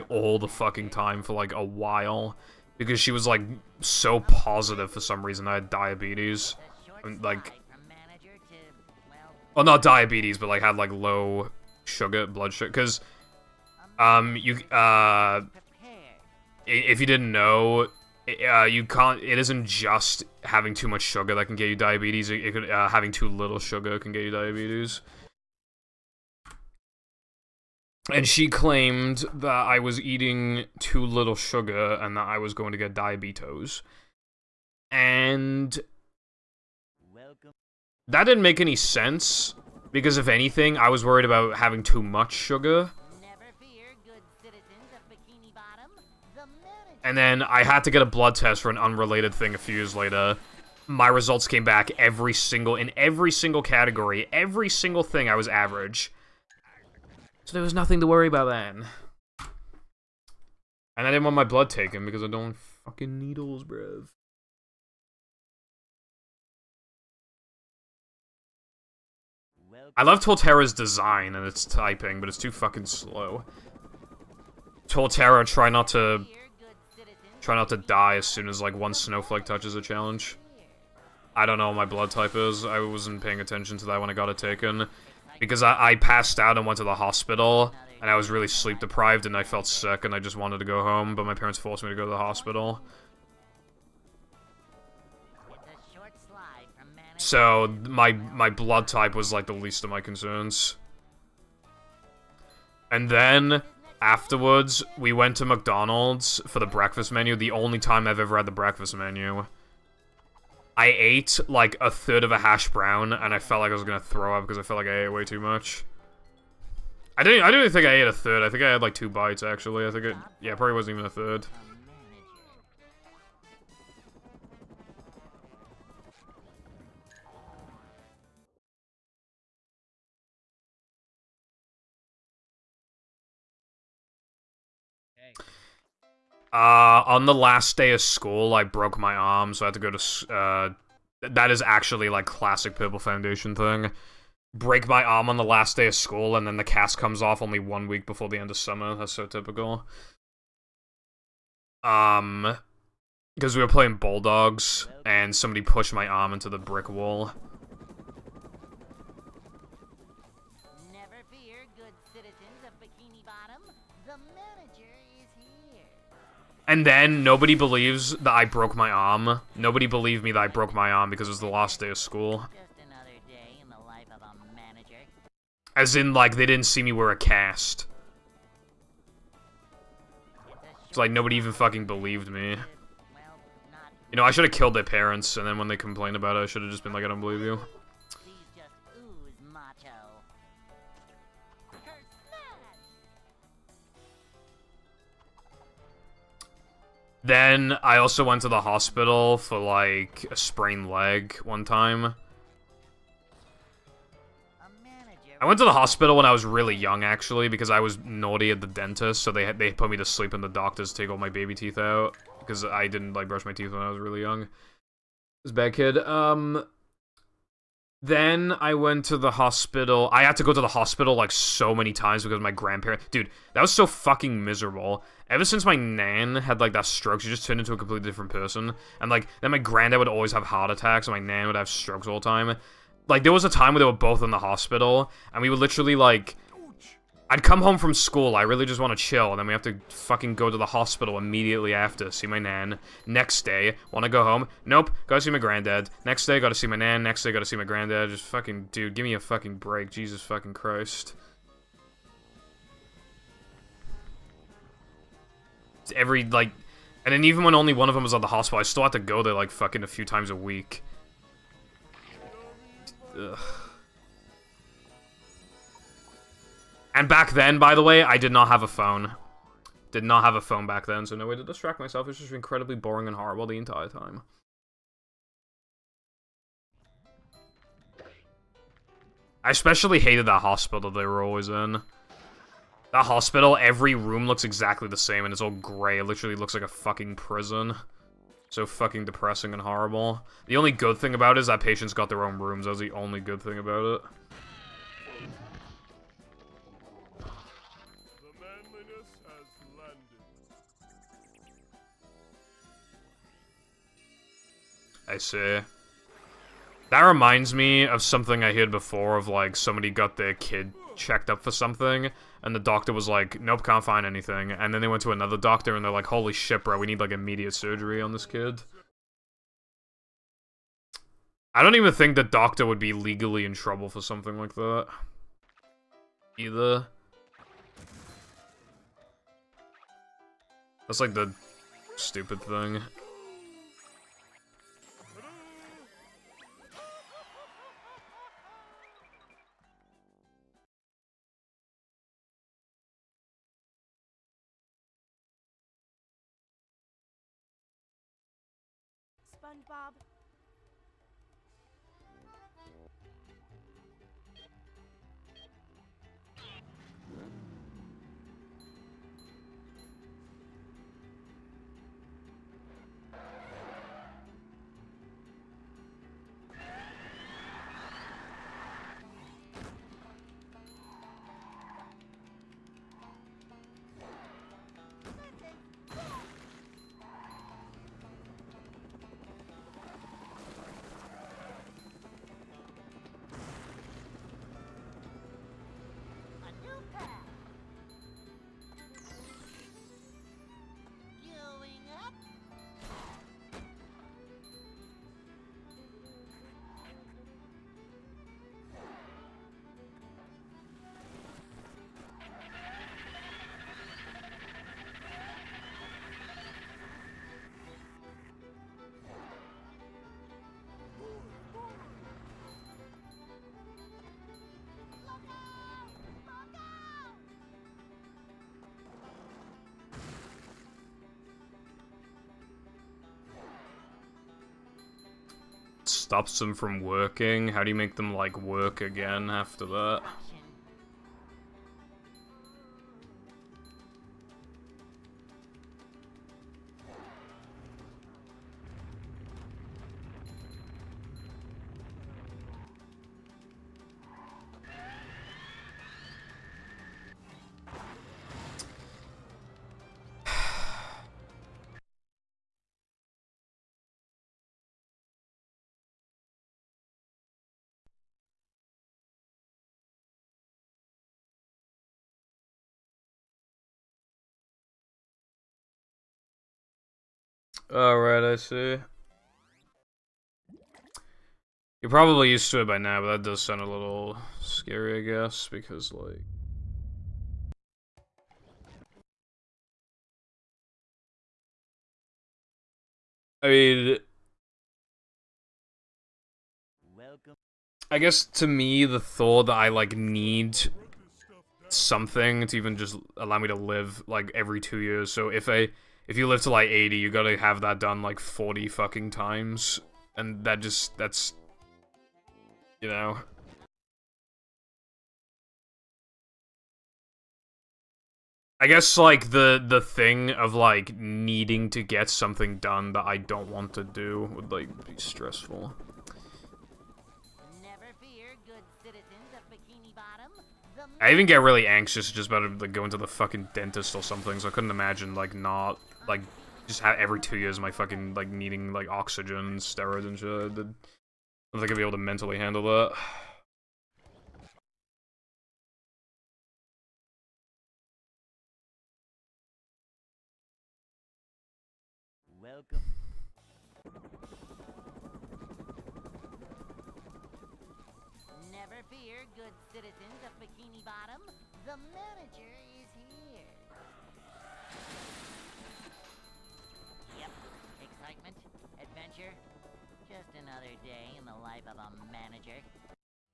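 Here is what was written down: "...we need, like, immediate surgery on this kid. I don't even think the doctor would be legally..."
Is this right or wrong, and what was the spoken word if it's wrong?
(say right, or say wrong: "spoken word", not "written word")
right.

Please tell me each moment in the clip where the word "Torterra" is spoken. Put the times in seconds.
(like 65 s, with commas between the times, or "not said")
70 s, 74 s.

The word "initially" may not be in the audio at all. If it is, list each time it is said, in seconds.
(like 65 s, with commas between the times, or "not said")
not said.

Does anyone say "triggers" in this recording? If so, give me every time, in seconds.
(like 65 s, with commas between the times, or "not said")
not said.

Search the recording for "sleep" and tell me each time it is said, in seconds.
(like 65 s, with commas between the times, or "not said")
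88 s, 210 s.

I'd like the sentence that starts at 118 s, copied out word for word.
I think I had like two bites actually.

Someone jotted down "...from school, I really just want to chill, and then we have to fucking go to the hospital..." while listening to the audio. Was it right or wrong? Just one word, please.
right.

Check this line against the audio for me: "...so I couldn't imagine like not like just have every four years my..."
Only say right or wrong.
wrong.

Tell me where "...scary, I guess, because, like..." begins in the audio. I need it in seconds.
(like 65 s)
474 s.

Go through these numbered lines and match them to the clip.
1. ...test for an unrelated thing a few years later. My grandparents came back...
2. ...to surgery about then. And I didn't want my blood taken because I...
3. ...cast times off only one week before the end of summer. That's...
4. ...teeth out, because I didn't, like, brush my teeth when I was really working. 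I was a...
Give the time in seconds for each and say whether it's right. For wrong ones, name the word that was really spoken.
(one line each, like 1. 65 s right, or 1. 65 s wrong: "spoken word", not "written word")
1. 48 s wrong: "results", not "grandparents"
2. 57 s wrong: "worry", not "surgery"
3. 146 s wrong: "comes", not "times"
4. 211 s wrong: "young", not "working".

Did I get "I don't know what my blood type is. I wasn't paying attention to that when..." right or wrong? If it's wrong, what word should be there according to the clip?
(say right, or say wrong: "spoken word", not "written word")
right.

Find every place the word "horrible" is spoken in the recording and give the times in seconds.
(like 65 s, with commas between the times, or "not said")
273 s, 289 s.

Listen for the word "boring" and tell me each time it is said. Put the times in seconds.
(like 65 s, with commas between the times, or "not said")
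272 s.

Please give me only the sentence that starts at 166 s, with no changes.
And then nobody believes that I broke my arm.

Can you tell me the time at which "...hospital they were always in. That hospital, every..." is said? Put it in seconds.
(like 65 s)
280 s.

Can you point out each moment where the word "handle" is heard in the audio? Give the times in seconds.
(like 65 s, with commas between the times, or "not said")
532 s.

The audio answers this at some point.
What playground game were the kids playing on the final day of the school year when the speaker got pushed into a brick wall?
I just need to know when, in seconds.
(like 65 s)
153 s.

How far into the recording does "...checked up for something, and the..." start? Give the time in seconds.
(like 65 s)
310 s.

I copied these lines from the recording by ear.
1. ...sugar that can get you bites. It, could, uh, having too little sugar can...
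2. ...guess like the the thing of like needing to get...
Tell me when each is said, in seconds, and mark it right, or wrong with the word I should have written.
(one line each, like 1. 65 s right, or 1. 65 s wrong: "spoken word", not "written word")
1. 21 s wrong: "diabetes", not "bites"
2. 508 s right.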